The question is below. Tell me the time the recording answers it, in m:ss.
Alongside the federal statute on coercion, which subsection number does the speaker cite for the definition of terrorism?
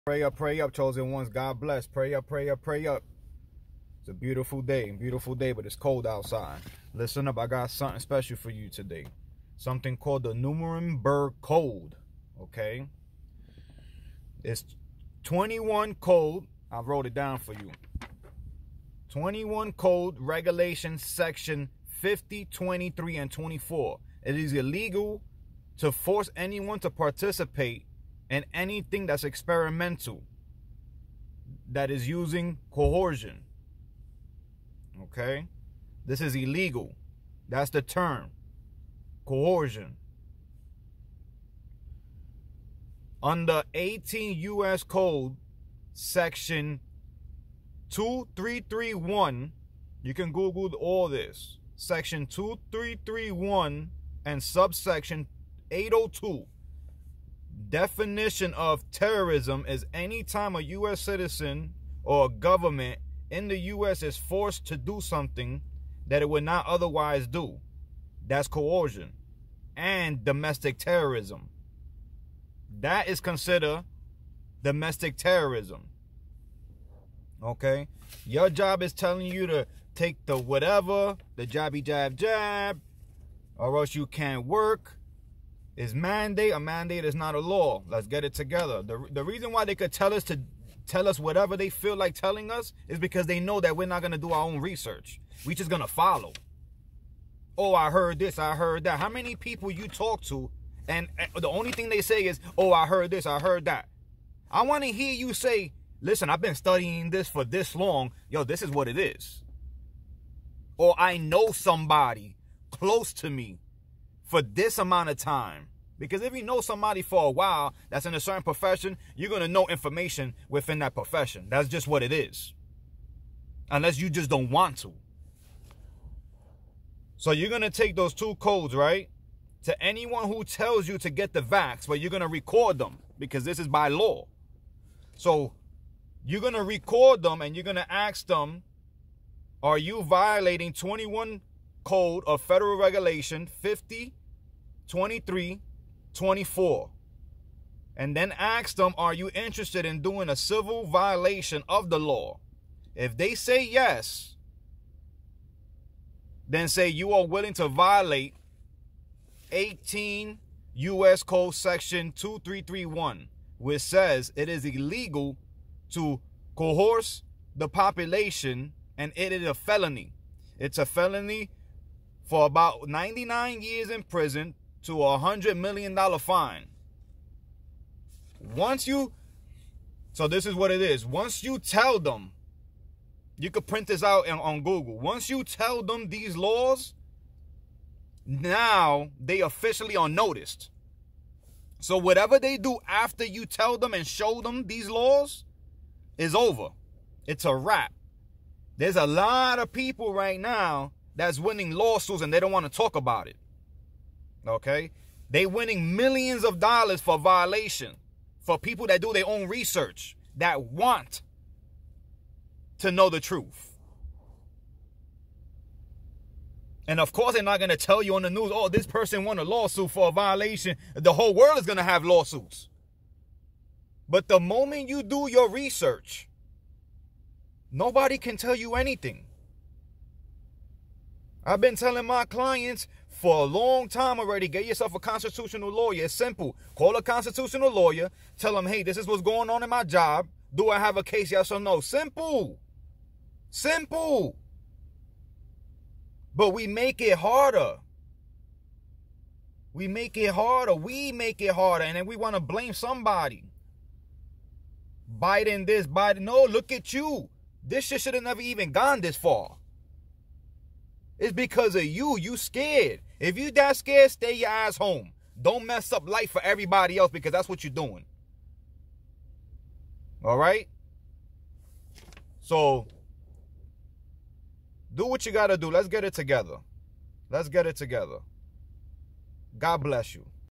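0:55.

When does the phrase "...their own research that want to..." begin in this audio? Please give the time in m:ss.
3:29.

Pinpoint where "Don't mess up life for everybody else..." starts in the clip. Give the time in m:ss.
4:25.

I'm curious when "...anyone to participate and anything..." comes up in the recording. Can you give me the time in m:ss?
0:26.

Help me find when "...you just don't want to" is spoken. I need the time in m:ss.
2:03.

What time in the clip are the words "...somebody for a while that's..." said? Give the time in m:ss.
1:56.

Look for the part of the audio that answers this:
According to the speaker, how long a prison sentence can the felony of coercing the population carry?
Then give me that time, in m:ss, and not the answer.
2:52.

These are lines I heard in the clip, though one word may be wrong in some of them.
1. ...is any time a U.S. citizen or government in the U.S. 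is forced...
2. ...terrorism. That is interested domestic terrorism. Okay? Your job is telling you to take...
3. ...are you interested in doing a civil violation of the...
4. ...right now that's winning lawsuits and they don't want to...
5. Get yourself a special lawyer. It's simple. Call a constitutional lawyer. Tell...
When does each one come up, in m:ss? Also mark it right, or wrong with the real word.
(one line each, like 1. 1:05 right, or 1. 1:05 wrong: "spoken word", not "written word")
1. 0:59 right
2. 1:10 wrong: "considered", not "interested"
3. 2:28 right
4. 3:20 right
5. 3:54 wrong: "constitutional", not "special".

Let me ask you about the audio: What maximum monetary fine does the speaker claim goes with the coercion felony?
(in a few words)
$100 million.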